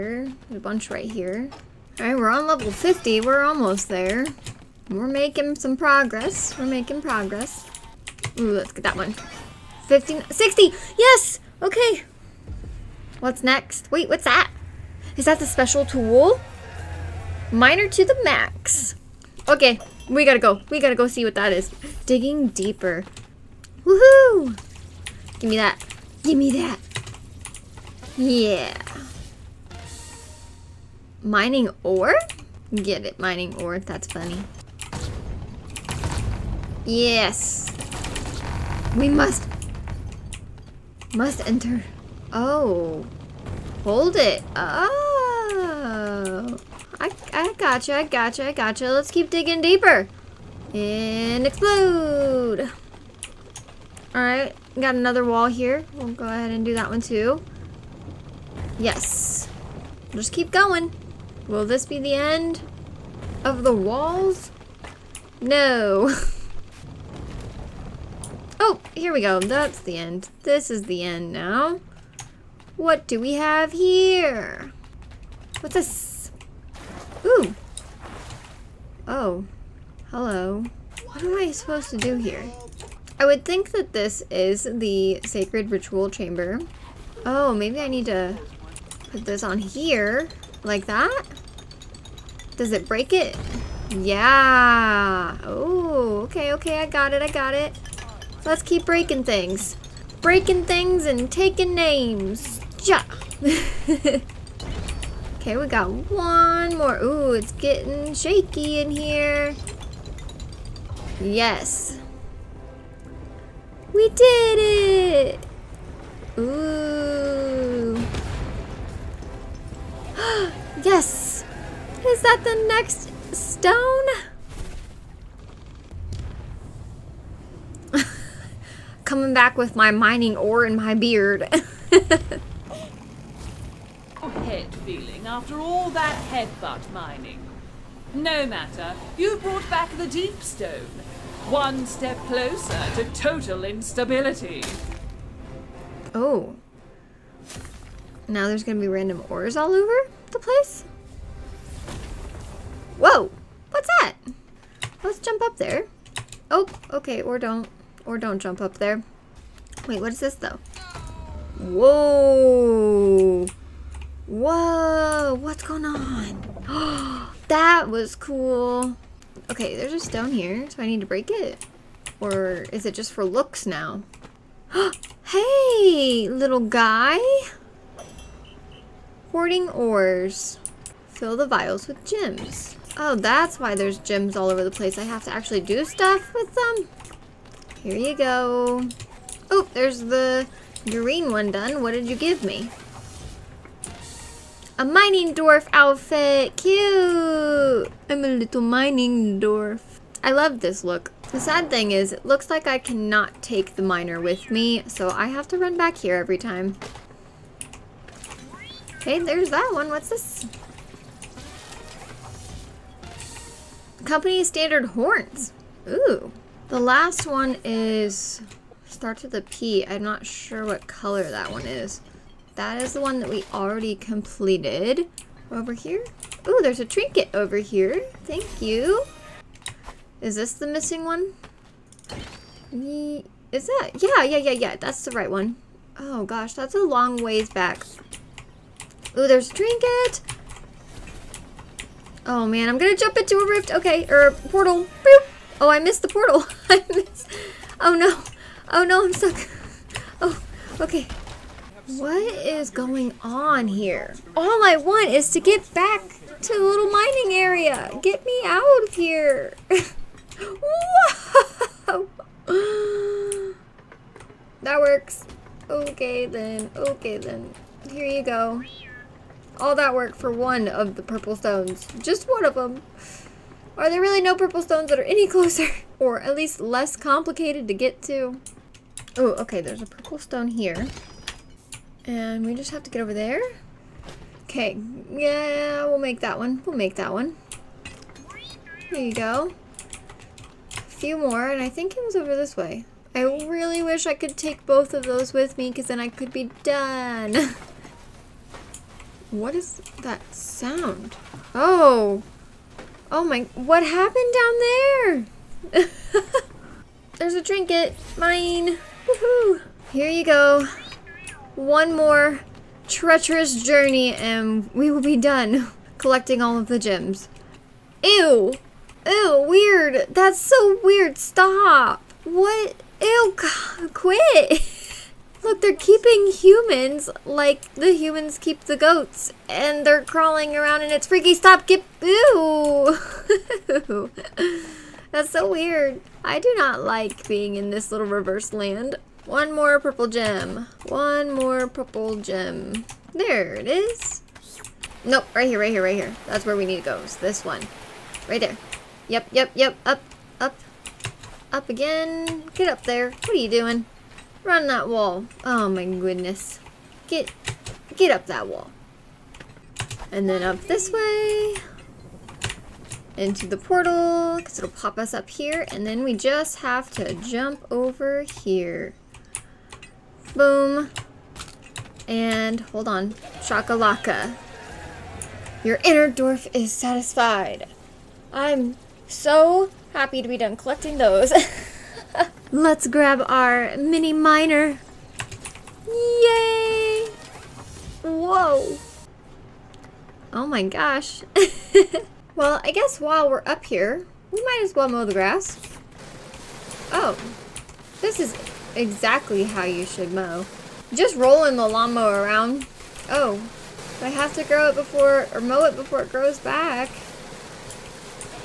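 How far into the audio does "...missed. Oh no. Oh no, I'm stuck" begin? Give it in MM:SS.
04:06.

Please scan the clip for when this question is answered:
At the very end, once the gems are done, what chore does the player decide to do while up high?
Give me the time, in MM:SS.
06:34.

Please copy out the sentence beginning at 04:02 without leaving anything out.
Oh man, I'm gonna jump into a rift.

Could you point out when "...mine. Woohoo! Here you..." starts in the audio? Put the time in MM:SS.
05:08.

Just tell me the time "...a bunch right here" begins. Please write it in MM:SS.
00:00.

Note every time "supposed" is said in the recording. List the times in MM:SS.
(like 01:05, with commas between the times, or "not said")
01:21.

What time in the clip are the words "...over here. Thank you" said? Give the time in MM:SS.
03:47.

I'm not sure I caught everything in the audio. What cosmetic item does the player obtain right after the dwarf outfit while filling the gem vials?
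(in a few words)
Company standard horns.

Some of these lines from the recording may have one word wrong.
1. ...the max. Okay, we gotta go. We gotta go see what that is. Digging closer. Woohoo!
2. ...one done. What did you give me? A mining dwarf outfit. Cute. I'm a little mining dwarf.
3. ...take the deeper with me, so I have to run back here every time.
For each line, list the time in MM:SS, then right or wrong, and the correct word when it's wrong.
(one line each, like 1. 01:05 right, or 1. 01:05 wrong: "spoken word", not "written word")
1. 00:18 wrong: "deeper", not "closer"
2. 03:11 right
3. 03:23 wrong: "miner", not "deeper".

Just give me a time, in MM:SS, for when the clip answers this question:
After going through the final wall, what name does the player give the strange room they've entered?
01:25.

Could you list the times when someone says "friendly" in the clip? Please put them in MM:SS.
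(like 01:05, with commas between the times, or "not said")
not said.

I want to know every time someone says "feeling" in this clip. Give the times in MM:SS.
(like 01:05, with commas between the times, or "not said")
02:14.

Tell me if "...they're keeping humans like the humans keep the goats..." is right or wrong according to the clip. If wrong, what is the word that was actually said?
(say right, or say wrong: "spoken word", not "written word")
right.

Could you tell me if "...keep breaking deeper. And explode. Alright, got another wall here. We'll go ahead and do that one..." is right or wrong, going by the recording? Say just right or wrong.
wrong.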